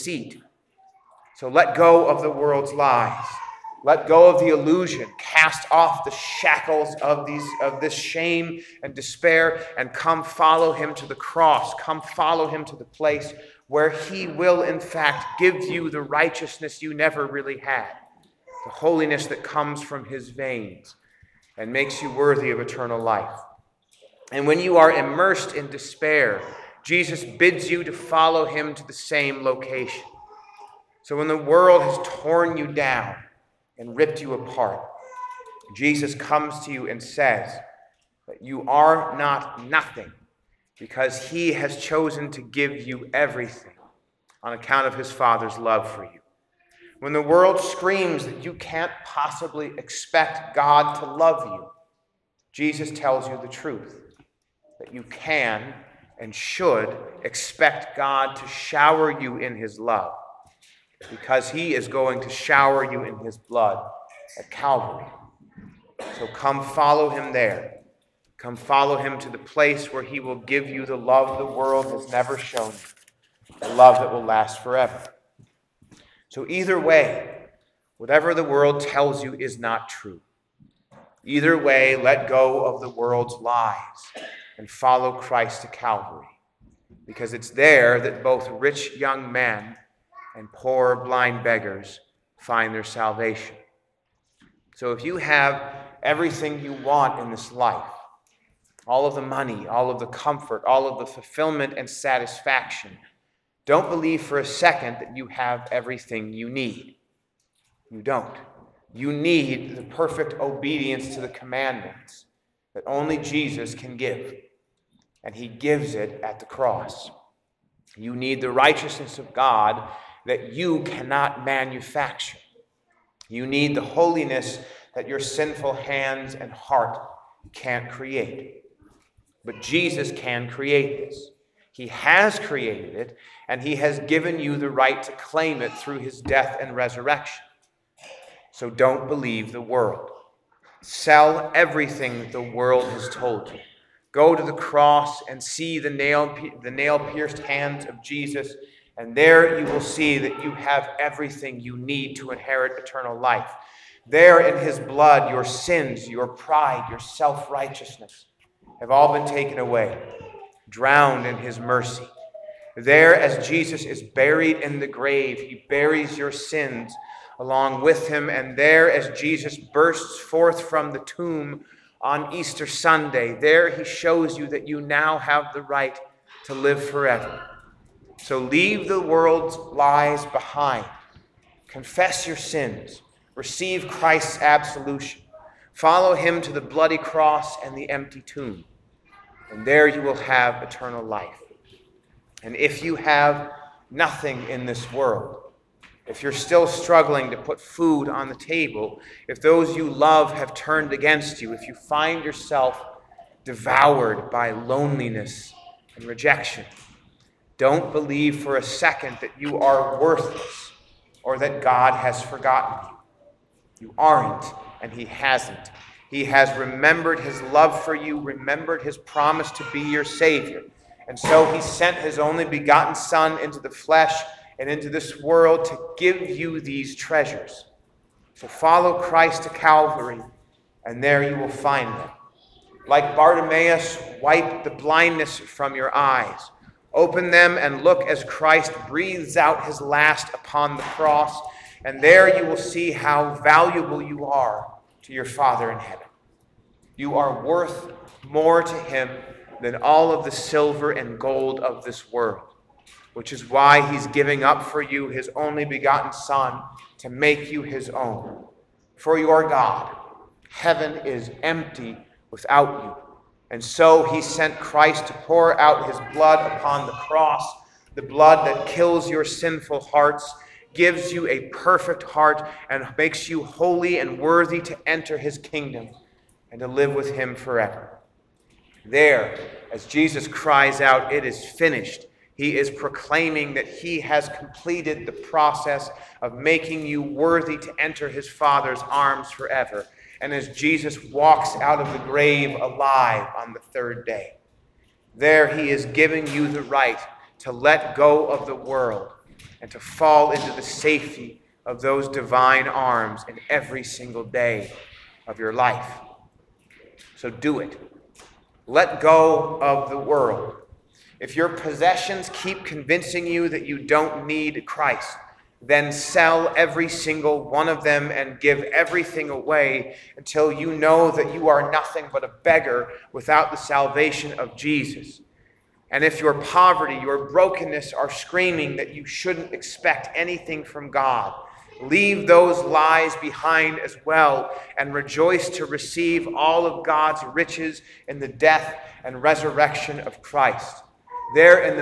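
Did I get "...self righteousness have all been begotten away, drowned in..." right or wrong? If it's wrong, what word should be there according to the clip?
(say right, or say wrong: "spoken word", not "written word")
wrong: "taken", not "begotten".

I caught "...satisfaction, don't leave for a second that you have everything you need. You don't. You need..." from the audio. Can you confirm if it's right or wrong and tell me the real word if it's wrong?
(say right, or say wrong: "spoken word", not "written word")
wrong: "believe", not "leave".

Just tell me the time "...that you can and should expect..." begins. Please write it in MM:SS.
00:54.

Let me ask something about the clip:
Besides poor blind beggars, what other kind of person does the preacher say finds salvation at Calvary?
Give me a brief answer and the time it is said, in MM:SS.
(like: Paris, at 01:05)
rich young men, at 01:28.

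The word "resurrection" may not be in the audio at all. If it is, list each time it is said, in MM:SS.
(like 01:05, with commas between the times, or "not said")
02:16, 05:39.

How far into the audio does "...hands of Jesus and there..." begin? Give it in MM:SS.
02:27.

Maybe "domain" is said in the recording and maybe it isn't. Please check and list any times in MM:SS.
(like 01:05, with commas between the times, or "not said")
not said.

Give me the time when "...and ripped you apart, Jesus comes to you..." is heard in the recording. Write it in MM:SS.
00:33.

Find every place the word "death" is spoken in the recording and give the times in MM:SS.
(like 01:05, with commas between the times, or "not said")
02:16, 05:38.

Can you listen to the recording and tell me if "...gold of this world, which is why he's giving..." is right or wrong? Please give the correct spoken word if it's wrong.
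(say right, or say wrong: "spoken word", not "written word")
right.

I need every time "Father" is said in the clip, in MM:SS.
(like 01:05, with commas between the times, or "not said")
00:45, 04:05, 04:48.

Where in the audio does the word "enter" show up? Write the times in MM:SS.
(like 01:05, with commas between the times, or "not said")
04:34, 04:47.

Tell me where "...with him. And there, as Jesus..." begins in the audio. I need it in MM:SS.
02:47.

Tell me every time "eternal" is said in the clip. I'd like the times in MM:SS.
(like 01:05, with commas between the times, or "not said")
00:22, 02:32, 03:10.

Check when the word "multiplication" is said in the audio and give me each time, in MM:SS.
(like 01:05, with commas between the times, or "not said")
not said.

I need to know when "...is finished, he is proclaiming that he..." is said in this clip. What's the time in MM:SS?
04:41.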